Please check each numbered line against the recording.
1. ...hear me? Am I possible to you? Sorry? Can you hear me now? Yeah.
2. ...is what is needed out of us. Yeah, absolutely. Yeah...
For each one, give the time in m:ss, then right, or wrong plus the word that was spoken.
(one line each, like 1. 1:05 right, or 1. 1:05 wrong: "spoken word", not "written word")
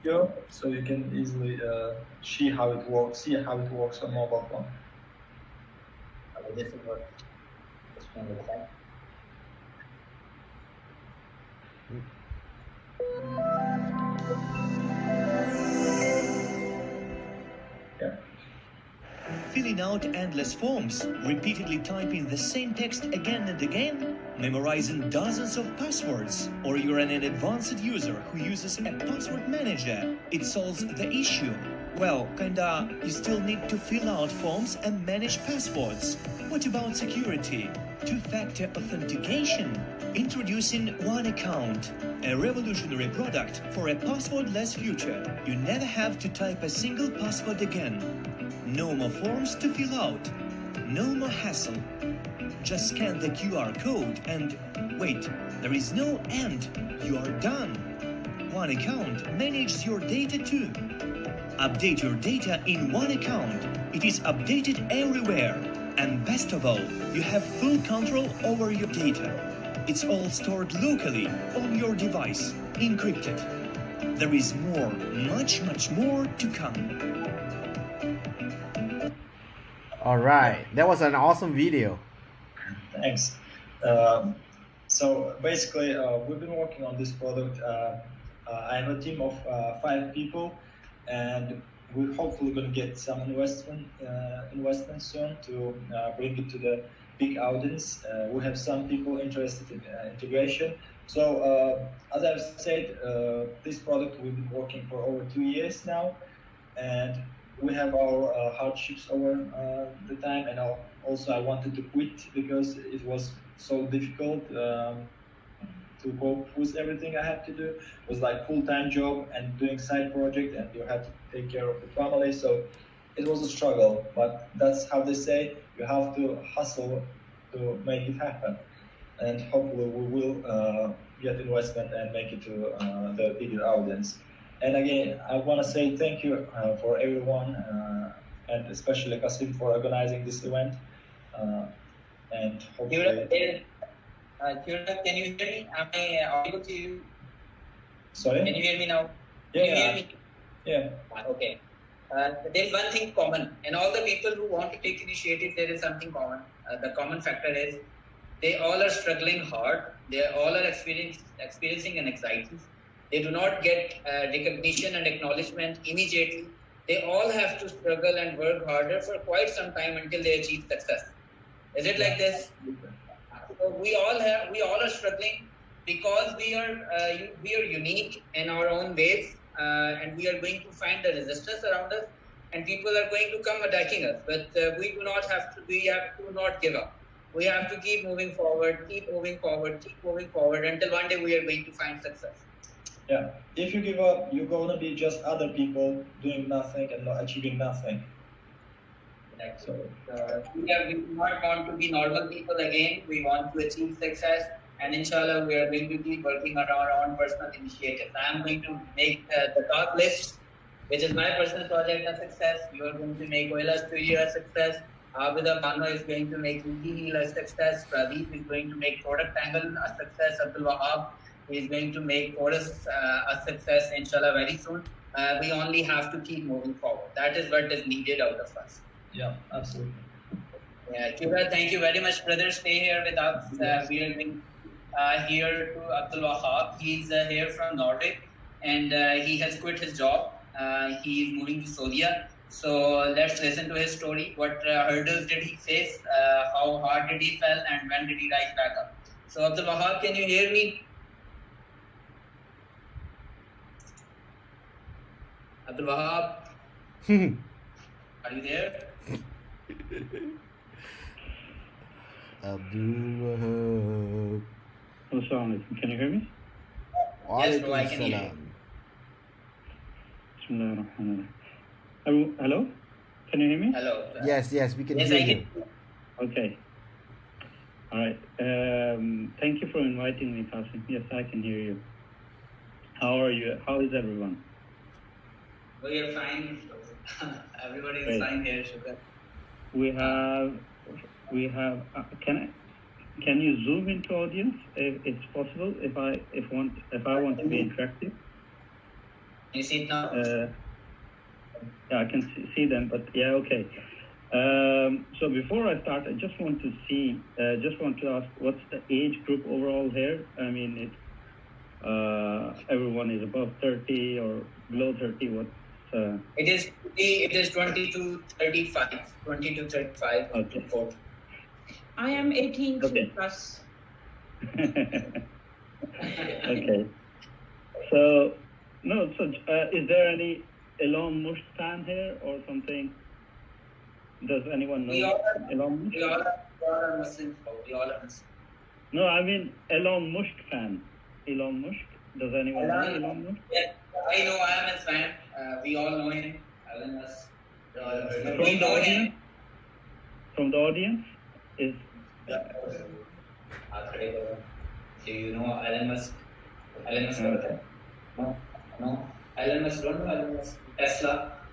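1. 2:25 wrong: "audible", not "possible"
2. 3:47 right.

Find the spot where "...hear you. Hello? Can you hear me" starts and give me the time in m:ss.
4:28.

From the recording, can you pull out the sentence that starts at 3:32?
You are going to make Oila's studio a success.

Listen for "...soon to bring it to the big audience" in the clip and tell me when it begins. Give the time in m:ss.
1:35.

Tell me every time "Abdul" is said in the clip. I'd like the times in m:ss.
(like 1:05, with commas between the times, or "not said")
3:40, 3:56, 4:09, 4:15, 4:22.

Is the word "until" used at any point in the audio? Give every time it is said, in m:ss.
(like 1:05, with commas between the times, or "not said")
2:49, 3:10.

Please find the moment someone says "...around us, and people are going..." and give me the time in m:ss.
3:01.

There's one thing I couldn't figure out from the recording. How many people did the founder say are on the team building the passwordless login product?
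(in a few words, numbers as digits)
5.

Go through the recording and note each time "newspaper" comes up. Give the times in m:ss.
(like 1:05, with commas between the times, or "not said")
not said.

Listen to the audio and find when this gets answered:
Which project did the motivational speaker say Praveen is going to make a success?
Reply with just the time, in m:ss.
3:39.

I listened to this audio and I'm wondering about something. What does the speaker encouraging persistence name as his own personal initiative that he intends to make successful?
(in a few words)
The top list.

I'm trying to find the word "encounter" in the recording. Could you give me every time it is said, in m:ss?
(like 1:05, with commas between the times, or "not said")
not said.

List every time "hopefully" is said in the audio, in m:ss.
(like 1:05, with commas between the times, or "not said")
1:32, 2:09, 2:22.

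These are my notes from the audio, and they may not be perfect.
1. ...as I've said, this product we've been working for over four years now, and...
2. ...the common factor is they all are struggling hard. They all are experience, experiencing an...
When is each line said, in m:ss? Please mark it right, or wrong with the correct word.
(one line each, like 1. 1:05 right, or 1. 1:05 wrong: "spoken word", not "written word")
1. 1:42 wrong: "two", not "four"
2. 2:36 right.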